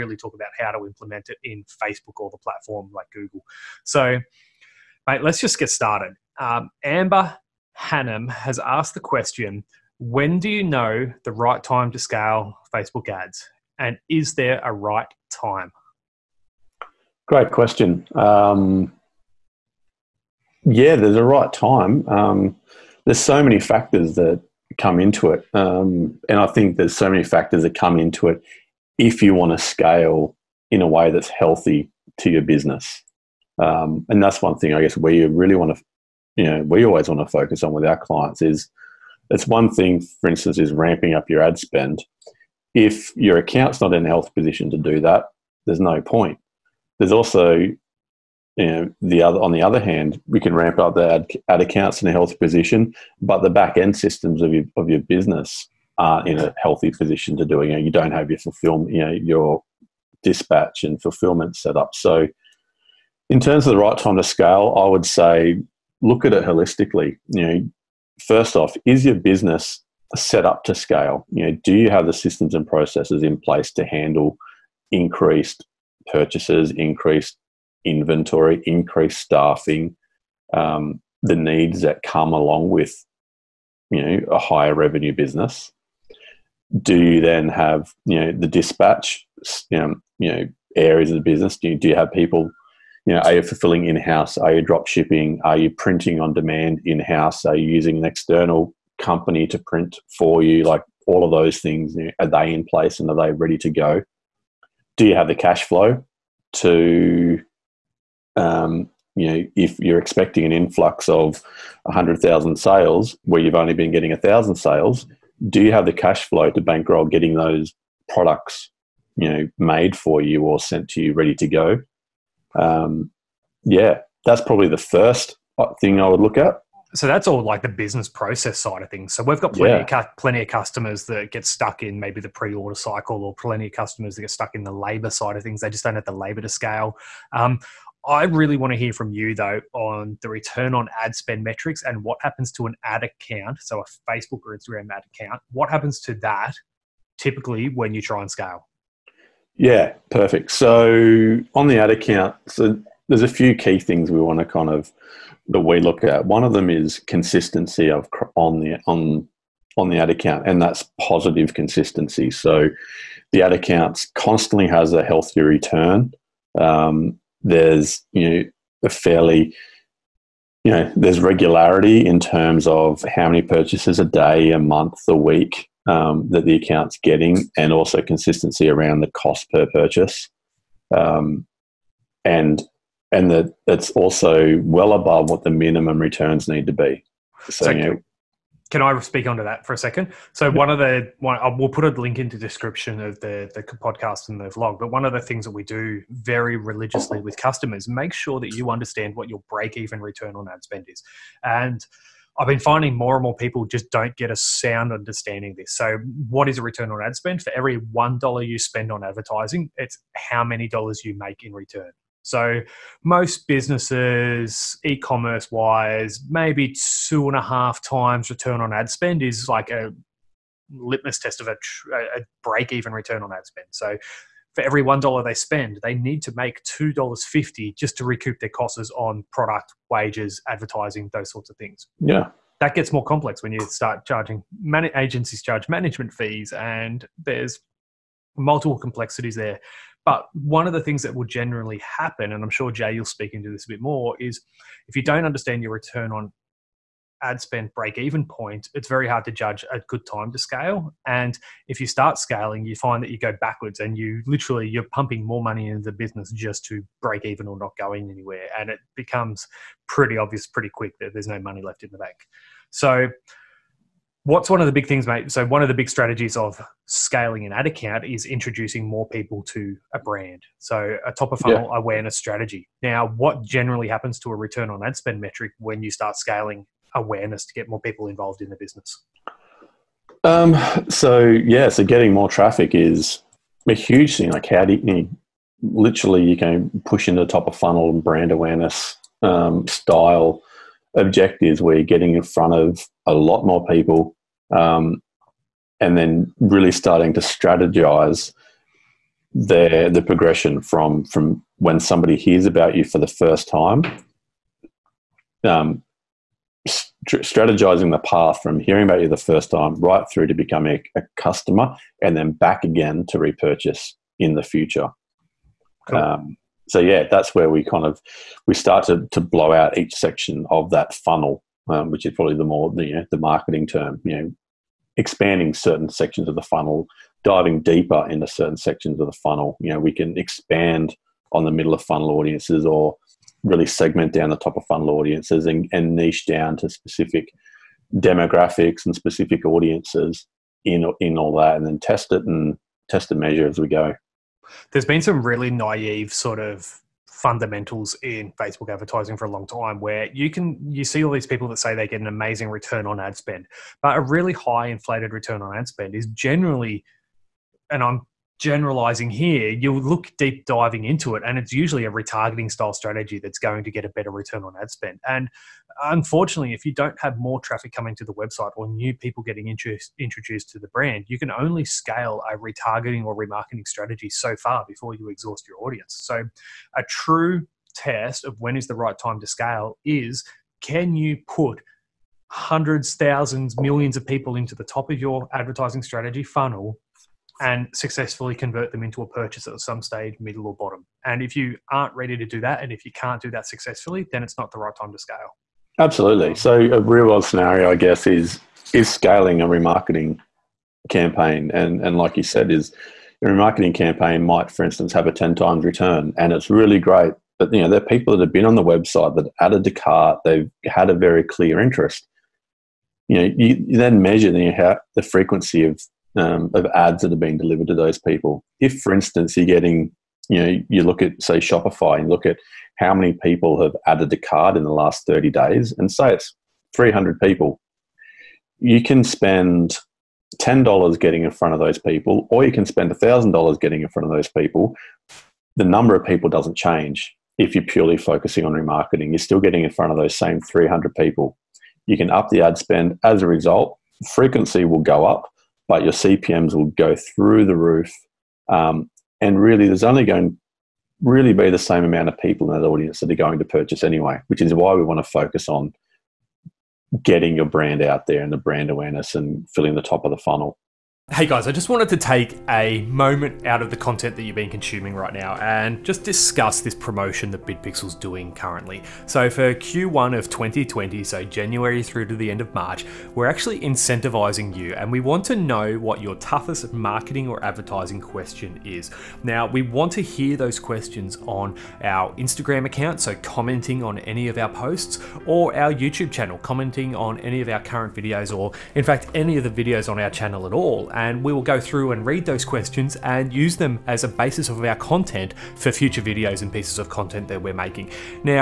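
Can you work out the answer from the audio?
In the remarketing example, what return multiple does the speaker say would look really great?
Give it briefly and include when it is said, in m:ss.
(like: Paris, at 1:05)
10 times, at 6:45.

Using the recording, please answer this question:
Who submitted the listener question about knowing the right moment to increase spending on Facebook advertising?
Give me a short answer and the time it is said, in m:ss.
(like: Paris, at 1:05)
Amber Hannam, at 0:06.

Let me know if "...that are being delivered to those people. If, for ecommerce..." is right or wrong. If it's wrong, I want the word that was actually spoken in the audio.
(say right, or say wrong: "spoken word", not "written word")
wrong: "instance", not "ecommerce".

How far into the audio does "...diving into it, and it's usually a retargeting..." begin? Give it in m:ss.
6:00.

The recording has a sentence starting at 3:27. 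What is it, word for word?
For every $1 you spend on advertising, it's how many dollars you make in return.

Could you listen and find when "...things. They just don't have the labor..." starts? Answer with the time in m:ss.
2:15.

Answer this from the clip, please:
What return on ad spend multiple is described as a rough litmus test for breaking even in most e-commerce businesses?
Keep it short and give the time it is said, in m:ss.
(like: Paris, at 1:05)
2.5 times, at 3:37.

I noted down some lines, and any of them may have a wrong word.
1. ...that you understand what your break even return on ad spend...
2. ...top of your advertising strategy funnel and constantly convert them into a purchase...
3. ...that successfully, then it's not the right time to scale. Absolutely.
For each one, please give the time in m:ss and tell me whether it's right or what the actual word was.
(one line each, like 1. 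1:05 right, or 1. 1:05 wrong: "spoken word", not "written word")
1. 3:18 right
2. 6:24 wrong: "successfully", not "constantly"
3. 6:33 right.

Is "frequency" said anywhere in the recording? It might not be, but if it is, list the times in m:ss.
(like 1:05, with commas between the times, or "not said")
6:55, 7:24.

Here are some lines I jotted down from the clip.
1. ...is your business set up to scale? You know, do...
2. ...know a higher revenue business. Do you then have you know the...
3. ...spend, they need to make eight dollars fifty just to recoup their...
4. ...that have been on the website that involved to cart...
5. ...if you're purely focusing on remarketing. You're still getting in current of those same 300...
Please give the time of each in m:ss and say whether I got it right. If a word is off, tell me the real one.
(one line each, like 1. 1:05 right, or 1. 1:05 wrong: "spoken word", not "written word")
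1. 1:08 right
2. 1:24 right
3. 3:45 wrong: "two", not "eight"
4. 6:48 wrong: "added", not "involved"
5. 7:17 wrong: "front", not "current".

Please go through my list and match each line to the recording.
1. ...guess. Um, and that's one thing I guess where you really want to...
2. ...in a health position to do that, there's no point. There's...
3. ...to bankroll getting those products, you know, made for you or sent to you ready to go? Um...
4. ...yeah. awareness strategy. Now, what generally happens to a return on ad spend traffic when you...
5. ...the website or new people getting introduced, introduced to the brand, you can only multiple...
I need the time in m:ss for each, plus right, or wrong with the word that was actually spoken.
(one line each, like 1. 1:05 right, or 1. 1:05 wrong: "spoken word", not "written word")
1. 0:32 wrong: "business", not "guess"
2. 0:43 right
3. 1:56 right
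4. 4:31 wrong: "metric", not "traffic"
5. 6:08 wrong: "scale", not "multiple".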